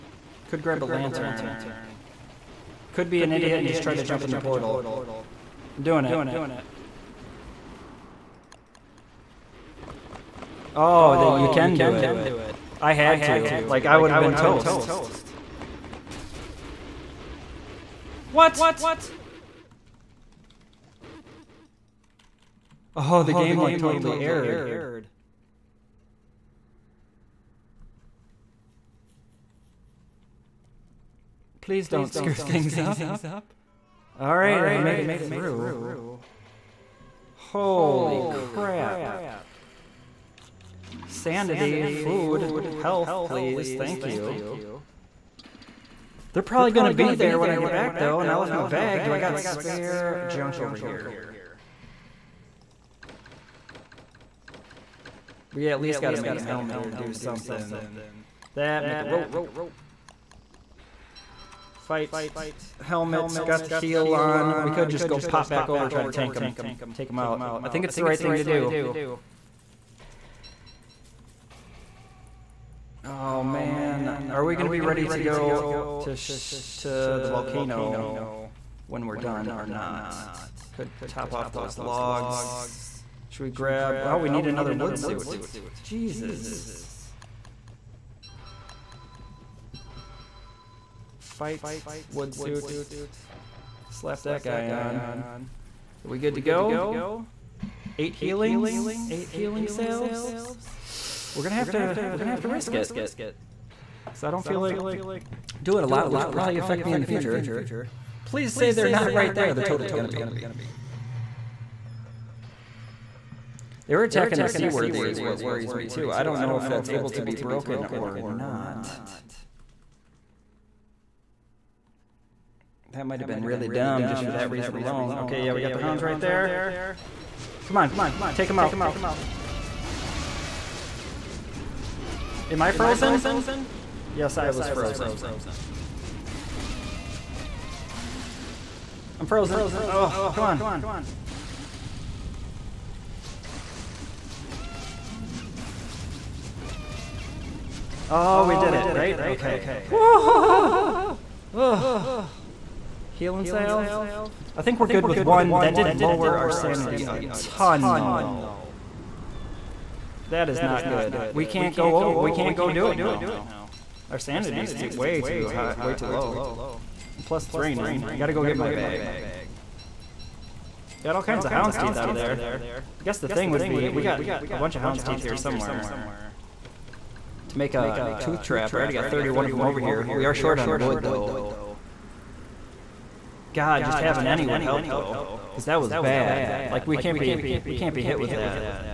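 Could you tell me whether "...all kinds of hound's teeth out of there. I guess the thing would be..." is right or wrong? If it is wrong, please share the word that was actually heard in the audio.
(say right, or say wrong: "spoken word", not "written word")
right.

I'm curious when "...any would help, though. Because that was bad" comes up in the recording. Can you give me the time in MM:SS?
03:04.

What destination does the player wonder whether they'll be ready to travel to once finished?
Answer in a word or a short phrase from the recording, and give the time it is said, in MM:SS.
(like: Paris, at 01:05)
The volcano, at 01:17.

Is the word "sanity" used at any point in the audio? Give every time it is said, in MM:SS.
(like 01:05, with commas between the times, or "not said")
00:41, 02:36, 02:44.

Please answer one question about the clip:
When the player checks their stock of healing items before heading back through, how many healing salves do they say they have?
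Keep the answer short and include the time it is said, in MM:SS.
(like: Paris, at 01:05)
8, at 01:39.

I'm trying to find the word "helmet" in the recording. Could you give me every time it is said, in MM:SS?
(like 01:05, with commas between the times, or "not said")
00:56, 01:02.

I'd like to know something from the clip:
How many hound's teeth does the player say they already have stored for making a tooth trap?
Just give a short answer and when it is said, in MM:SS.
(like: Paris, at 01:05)
31, at 02:59.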